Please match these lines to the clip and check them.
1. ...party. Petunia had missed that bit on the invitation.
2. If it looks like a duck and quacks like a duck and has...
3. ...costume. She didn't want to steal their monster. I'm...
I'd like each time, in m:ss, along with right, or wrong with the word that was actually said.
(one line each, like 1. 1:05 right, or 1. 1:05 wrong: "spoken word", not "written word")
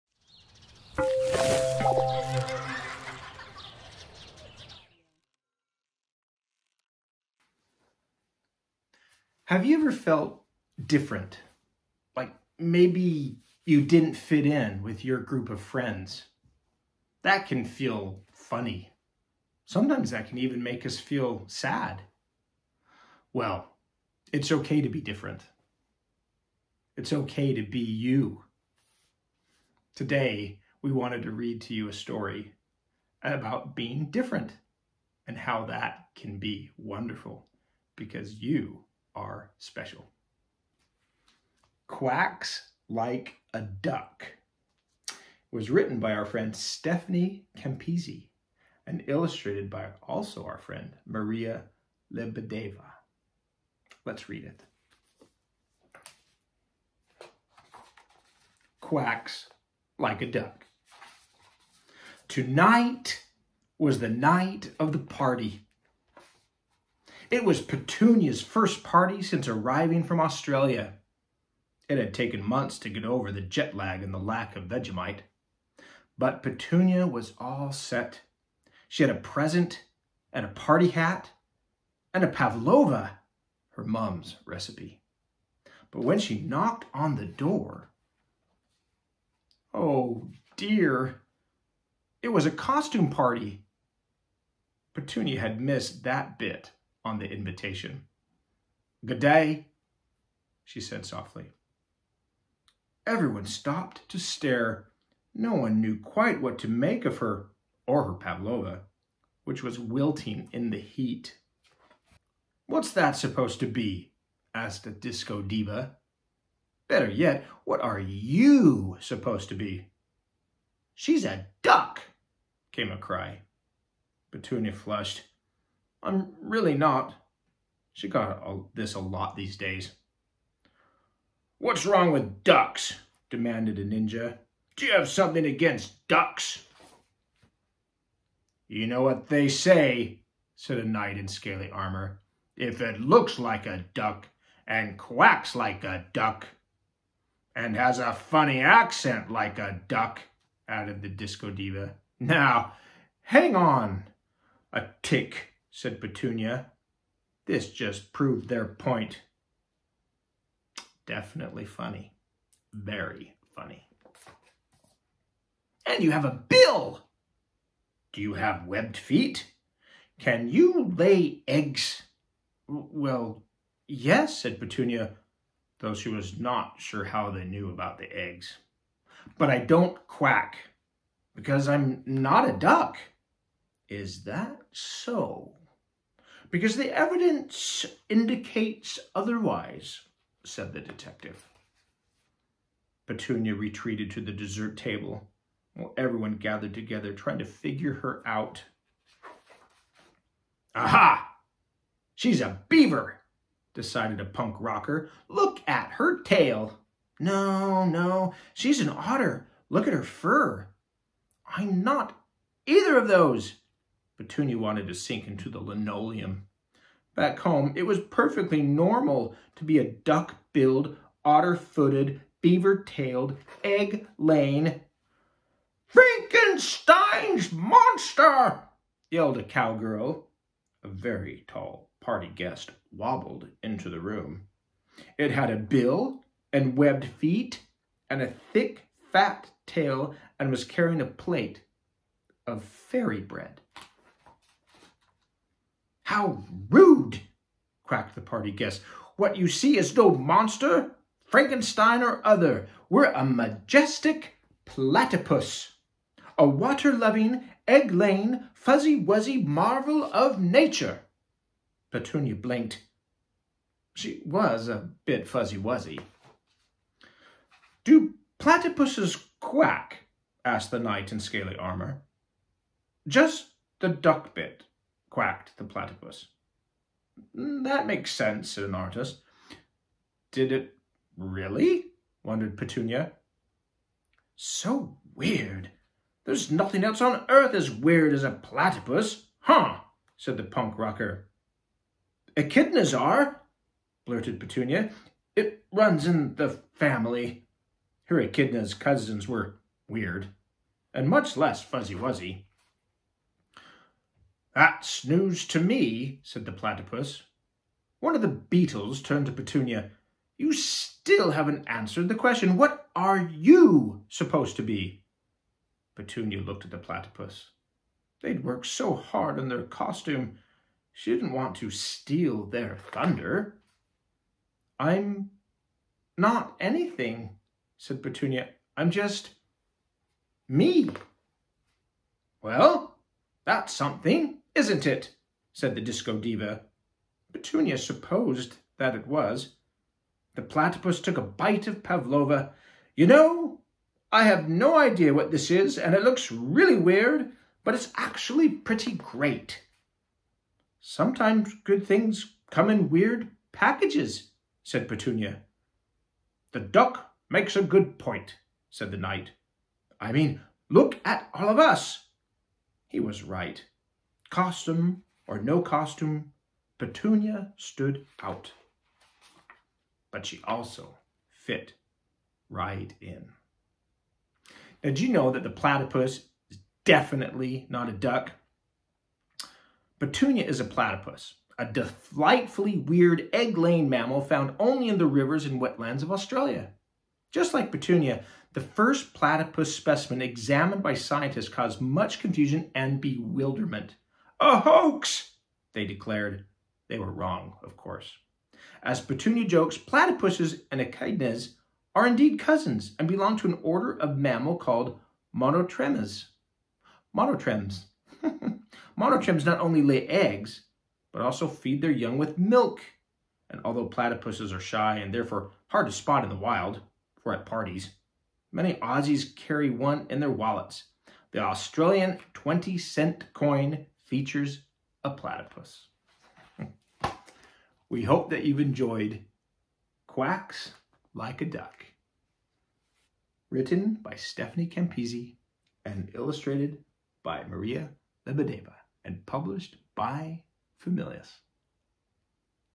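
1. 1:33 right
2. 2:22 right
3. 5:19 wrong: "thunder", not "monster".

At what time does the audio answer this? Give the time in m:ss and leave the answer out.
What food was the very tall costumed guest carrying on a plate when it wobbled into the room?
4:02.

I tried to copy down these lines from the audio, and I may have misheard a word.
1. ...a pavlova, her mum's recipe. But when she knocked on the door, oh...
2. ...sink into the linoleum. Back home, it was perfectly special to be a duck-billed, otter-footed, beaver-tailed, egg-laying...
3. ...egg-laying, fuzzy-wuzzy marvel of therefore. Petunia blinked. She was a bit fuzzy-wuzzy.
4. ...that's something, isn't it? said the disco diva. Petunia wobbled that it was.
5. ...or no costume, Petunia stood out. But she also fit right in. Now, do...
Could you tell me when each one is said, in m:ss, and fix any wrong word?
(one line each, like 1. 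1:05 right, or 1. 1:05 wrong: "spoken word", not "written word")
1. 1:22 right
2. 3:34 wrong: "normal", not "special"
3. 4:17 wrong: "nature", not "therefore"
4. 5:33 wrong: "supposed", not "wobbled"
5. 6:05 right.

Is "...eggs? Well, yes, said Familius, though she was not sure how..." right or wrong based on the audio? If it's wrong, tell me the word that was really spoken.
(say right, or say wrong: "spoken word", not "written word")
wrong: "Petunia", not "Familius".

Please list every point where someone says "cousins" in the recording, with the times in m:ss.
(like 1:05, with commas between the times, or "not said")
4:58, 6:42.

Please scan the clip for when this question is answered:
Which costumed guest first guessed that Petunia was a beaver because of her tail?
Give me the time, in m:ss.
3:24.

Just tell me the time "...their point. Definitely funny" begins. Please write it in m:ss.
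2:38.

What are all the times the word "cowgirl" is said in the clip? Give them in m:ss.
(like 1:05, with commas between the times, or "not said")
3:49.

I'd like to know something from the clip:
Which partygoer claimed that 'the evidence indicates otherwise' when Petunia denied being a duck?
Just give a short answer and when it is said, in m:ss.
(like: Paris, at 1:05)
the detective, at 3:10.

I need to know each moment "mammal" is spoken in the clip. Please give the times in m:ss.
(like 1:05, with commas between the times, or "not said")
6:23, 6:44.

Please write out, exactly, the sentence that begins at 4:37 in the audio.
Mm, that makes sense, said an artist.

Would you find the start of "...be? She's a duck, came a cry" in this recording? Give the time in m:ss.
1:59.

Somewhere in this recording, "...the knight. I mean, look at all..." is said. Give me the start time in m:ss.
5:58.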